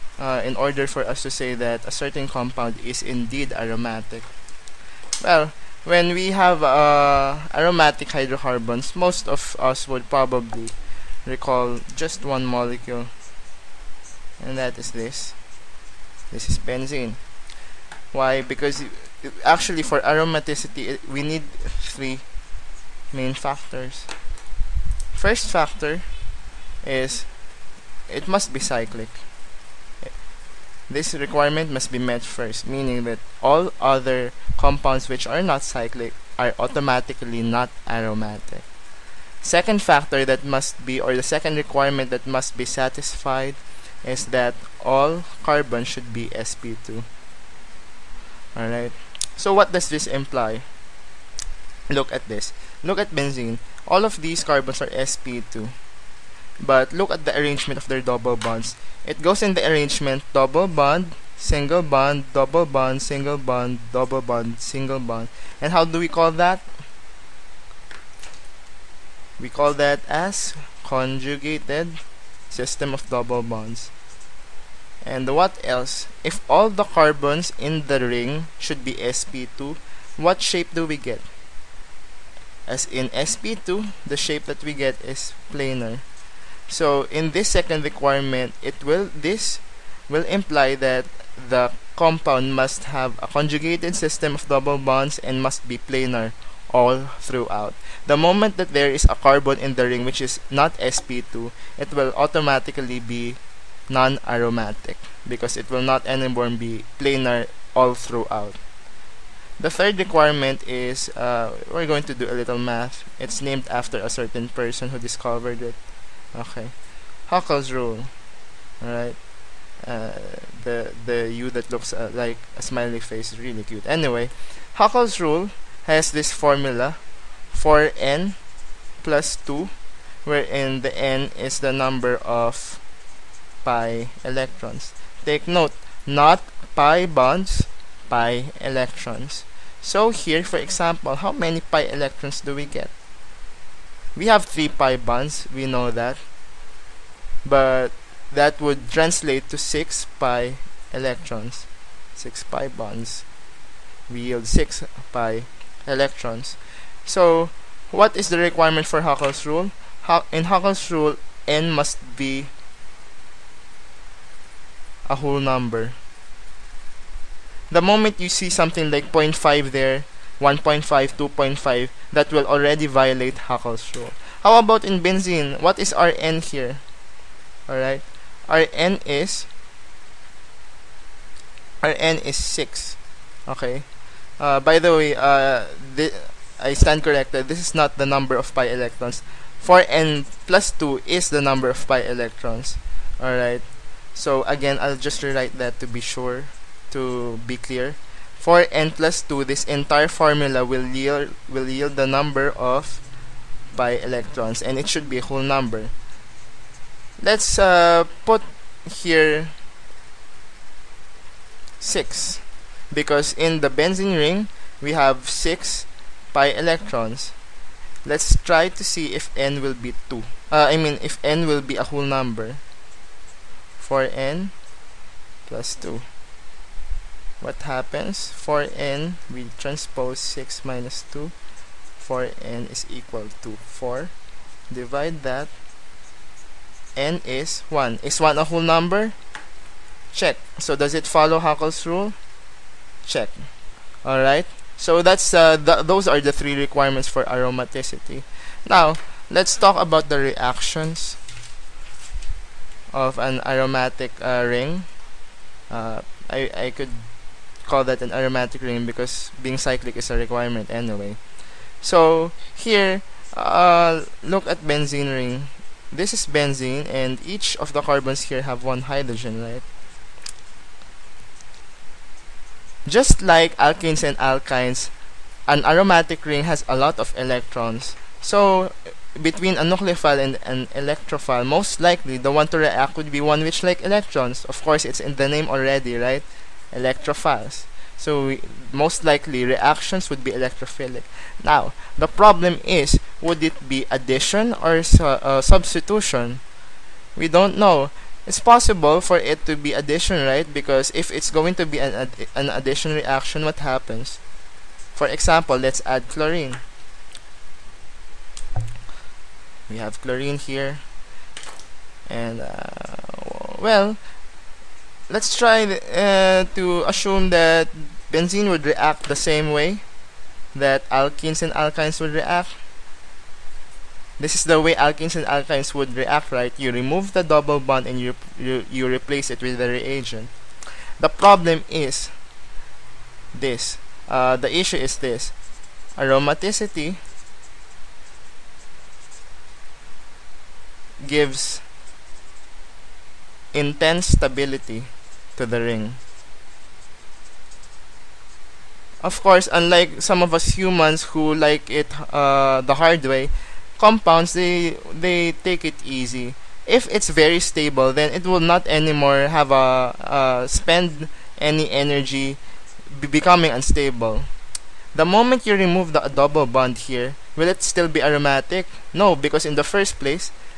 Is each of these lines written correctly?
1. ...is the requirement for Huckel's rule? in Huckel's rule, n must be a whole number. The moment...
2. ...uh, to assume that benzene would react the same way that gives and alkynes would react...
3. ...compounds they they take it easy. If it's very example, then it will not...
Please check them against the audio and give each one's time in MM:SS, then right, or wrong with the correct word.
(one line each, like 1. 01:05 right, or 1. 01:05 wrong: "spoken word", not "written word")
1. 02:38 right
2. 05:15 wrong: "alkenes", not "gives"
3. 05:53 wrong: "stable", not "example".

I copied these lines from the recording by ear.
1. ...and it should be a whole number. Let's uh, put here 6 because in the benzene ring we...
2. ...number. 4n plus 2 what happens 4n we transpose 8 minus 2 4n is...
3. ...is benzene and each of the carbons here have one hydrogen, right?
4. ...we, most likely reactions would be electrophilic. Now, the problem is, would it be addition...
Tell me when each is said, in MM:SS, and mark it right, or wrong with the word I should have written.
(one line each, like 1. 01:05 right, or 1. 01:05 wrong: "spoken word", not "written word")
1. 03:24 right
2. 03:42 wrong: "6", not "8"
3. 04:26 right
4. 04:48 right.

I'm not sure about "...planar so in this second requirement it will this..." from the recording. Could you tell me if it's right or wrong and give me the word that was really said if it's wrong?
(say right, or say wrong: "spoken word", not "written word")
right.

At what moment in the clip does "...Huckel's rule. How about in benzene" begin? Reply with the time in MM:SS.
02:53.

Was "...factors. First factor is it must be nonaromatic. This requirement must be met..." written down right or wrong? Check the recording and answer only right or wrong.
wrong.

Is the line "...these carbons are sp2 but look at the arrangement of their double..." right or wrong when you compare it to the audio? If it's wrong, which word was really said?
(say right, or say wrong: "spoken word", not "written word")
right.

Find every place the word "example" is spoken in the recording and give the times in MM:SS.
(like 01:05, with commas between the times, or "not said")
02:20, 05:05.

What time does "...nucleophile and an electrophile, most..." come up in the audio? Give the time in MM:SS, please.
04:39.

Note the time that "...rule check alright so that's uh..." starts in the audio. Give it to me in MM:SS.
04:01.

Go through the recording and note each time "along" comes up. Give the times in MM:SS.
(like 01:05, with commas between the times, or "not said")
not said.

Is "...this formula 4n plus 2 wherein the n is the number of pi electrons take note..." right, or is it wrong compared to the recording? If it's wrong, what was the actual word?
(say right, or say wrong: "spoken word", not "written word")
right.